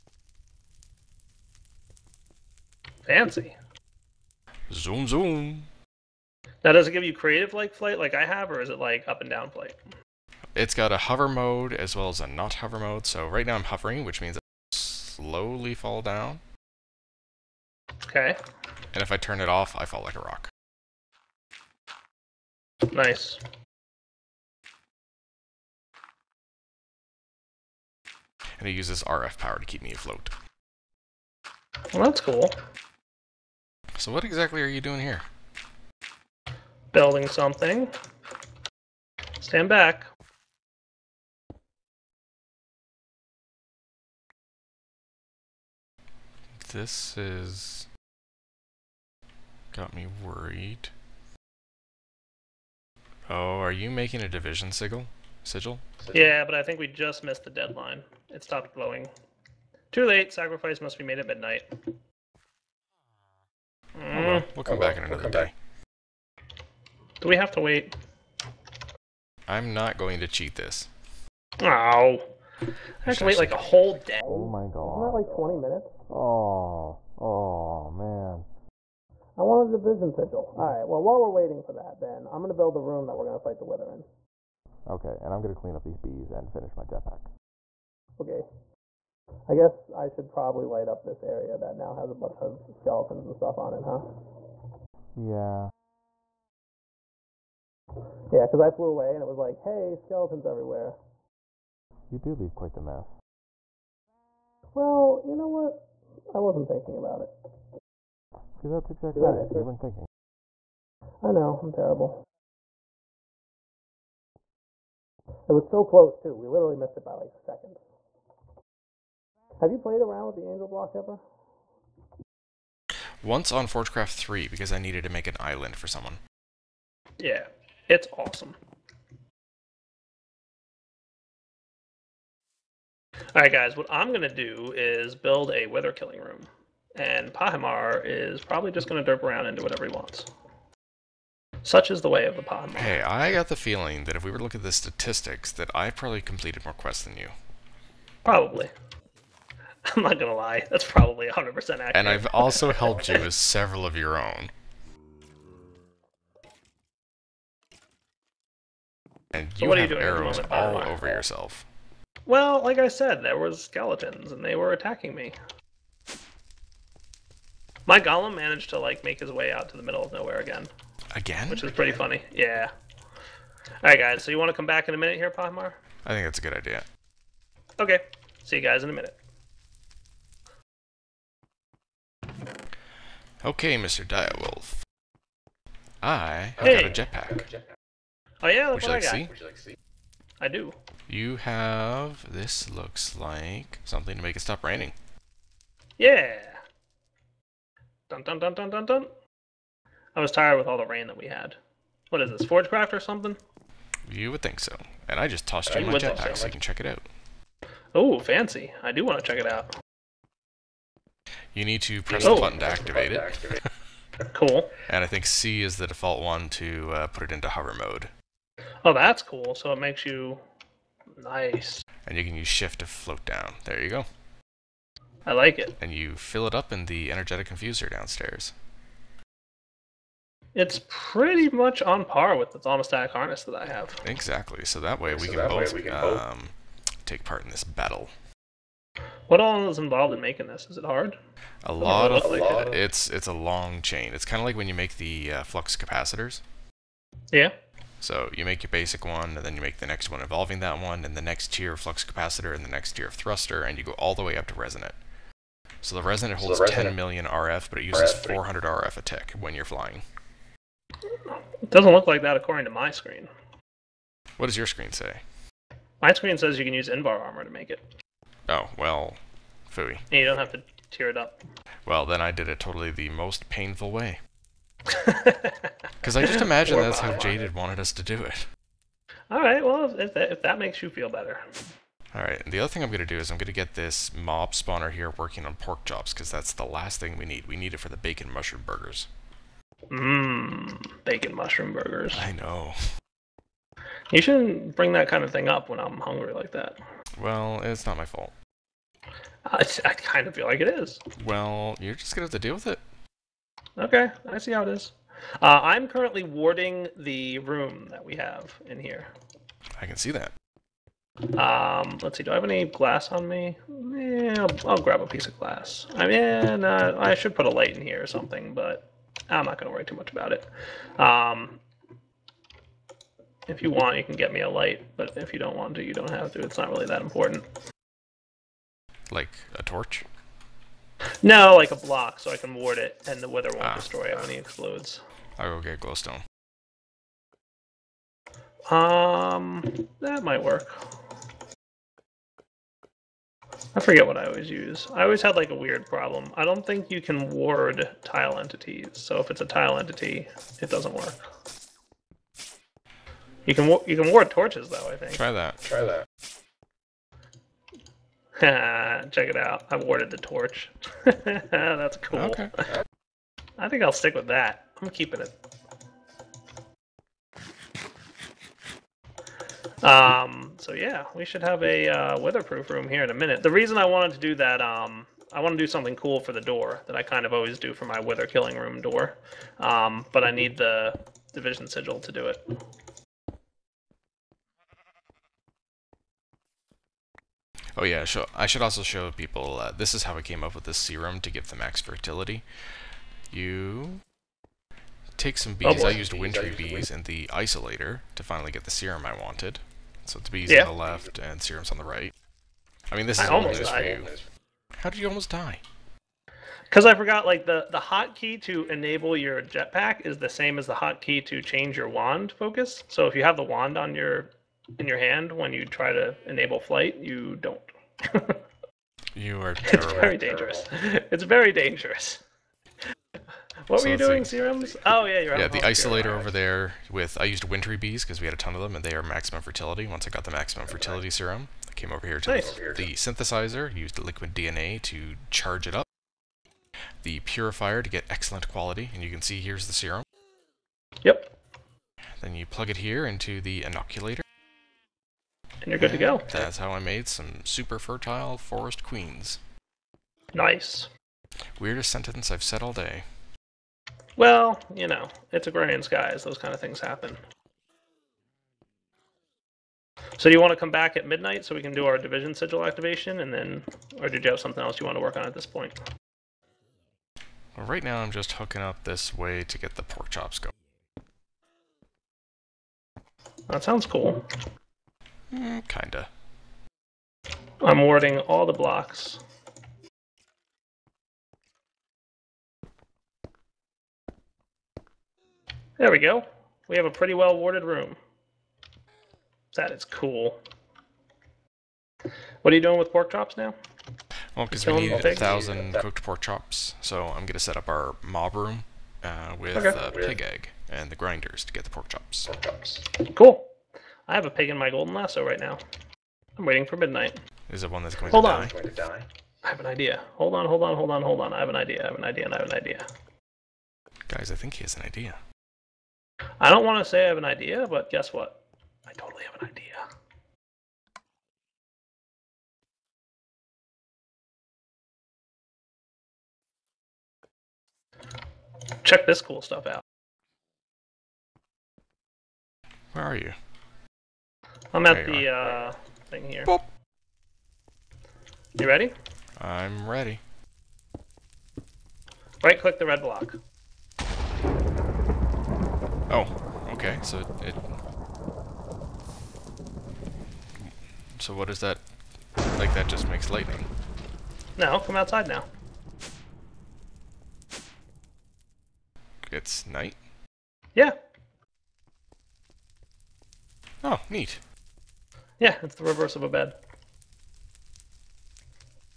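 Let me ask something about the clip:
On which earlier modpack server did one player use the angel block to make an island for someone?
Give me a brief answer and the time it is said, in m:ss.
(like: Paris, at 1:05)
Forgecraft 3, at 2:03.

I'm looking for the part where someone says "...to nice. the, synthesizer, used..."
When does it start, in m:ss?
7:12.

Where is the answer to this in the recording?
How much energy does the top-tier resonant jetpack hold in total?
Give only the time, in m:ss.
4:16.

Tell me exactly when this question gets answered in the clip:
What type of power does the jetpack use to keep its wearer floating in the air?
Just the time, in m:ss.
0:29.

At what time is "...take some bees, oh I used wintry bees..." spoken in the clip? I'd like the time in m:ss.
6:35.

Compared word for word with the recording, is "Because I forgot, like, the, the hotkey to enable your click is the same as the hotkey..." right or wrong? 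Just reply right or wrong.
wrong.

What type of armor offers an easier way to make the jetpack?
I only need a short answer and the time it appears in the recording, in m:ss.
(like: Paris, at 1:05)
Invar armor, at 4:26.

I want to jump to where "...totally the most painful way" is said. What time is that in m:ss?
4:32.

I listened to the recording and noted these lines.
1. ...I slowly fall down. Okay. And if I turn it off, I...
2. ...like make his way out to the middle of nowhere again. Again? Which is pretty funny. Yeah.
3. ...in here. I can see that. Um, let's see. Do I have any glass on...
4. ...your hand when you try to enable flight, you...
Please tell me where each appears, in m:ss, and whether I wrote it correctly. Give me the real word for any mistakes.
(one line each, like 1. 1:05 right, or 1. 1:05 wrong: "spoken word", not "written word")
1. 0:14 right
2. 2:48 right
3. 5:08 right
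4. 6:54 right.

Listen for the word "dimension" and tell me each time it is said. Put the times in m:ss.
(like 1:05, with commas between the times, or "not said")
not said.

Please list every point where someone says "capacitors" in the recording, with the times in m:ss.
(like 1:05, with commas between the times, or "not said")
4:05, 4:12.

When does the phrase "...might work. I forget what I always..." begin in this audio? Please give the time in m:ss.
5:40.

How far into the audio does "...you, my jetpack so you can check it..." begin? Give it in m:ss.
3:25.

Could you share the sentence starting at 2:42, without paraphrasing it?
Well, like I said, there was skeletons, and they were attacking me.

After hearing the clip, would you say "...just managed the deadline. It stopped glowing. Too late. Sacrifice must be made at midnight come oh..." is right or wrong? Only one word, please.
wrong.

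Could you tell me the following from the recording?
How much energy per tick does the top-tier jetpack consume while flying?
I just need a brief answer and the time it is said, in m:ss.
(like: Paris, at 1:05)
400 RF, at 4:18.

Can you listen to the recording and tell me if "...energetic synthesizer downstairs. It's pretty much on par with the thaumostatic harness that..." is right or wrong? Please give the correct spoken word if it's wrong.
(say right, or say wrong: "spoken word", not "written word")
wrong: "infuser", not "synthesizer".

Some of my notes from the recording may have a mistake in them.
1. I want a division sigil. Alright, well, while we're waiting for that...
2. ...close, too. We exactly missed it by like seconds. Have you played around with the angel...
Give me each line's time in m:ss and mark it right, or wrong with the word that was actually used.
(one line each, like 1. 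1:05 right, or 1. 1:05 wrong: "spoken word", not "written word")
1. 1:19 right
2. 1:55 wrong: "literally", not "exactly".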